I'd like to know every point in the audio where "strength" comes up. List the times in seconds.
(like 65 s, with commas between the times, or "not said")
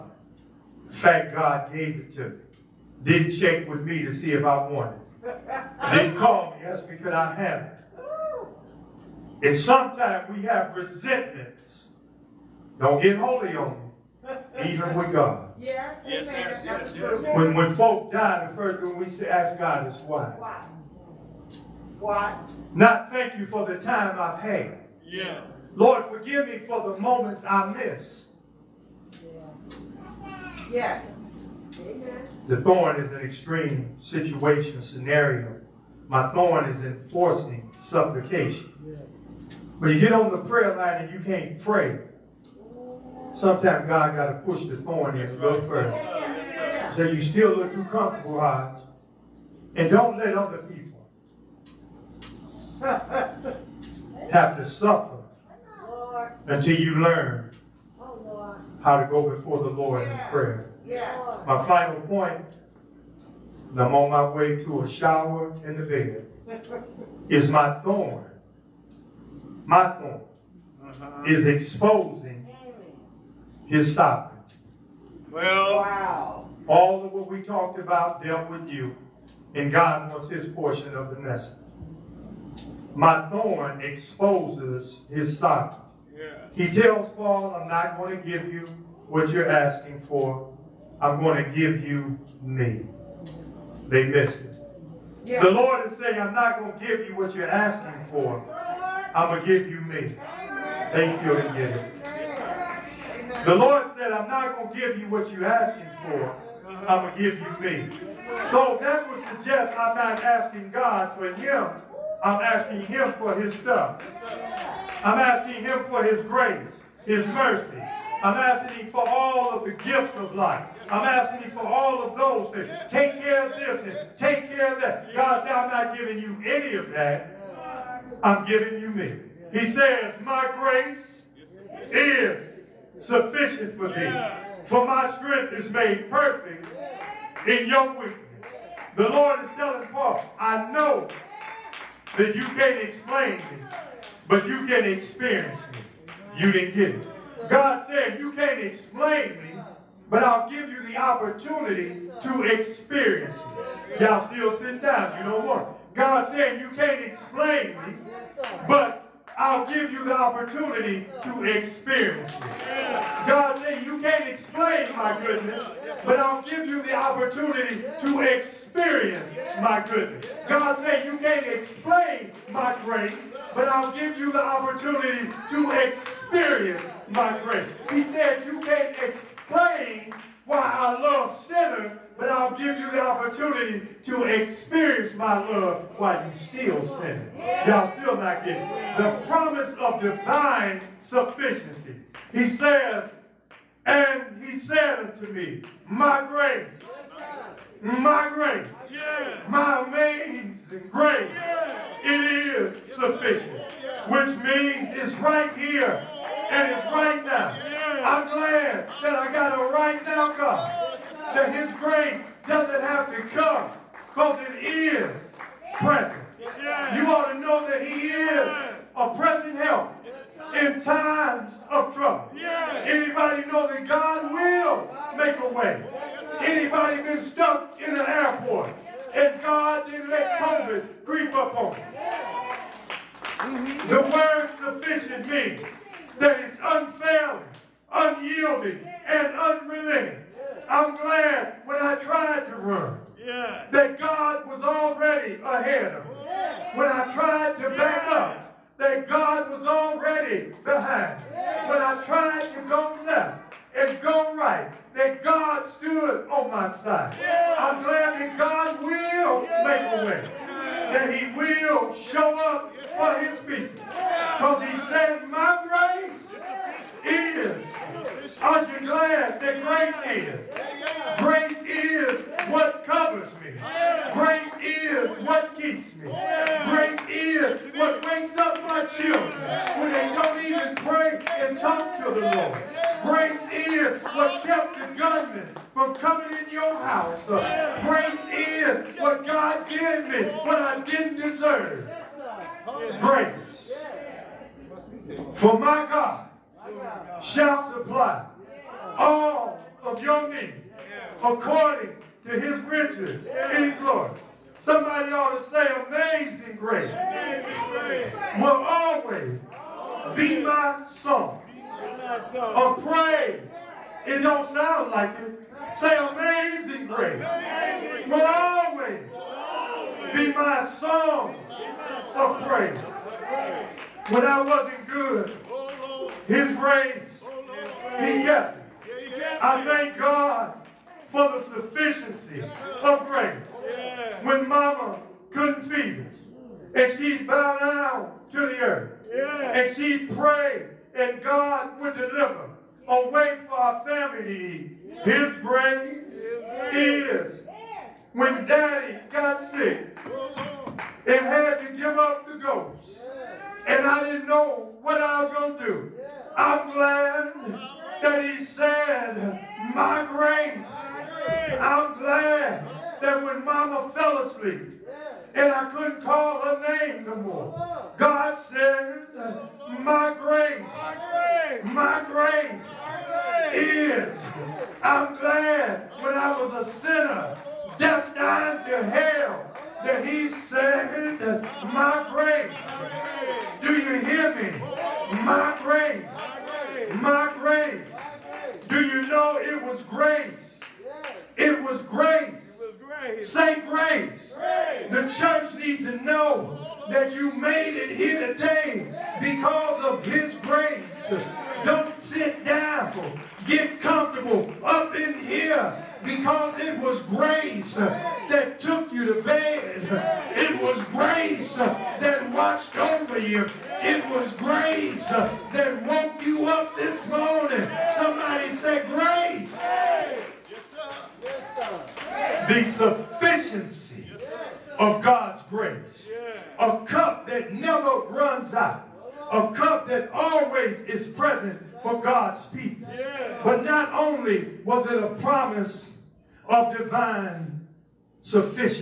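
135 s.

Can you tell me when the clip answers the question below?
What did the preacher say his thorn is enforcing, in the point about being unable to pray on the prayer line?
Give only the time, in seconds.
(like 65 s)
37 s.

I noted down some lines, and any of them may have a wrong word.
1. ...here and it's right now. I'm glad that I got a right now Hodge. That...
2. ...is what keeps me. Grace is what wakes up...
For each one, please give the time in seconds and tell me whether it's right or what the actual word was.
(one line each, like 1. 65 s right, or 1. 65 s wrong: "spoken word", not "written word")
1. 205 s wrong: "God", not "Hodge"
2. 274 s right.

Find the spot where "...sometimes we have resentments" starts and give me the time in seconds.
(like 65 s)
9 s.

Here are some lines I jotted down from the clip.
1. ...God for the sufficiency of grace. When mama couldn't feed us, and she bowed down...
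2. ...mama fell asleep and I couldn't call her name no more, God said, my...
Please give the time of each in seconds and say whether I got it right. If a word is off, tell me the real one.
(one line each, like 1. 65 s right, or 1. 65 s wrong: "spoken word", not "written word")
1. 329 s right
2. 363 s right.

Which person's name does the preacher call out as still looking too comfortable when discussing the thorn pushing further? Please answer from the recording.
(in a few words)
Hodge.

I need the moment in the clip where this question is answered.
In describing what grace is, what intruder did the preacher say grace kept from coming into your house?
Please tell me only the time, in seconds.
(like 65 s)
284 s.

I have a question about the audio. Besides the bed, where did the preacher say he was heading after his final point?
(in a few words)
a shower.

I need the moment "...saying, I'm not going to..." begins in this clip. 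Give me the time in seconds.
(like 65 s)
95 s.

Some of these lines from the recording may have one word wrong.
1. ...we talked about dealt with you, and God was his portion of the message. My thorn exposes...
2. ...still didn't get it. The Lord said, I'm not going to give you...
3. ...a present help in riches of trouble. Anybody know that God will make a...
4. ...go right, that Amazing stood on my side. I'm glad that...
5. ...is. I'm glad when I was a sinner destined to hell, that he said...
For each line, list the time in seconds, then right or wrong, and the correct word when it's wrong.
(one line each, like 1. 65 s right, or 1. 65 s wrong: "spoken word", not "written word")
1. 77 s right
2. 101 s right
3. 218 s wrong: "times", not "riches"
4. 254 s wrong: "God", not "Amazing"
5. 373 s right.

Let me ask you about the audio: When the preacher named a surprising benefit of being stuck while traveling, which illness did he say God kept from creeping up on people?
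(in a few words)
COVID.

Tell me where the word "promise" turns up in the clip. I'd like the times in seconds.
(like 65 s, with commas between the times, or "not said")
189 s, 435 s.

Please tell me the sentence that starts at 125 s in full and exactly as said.
God said, I'm not giving you any of that.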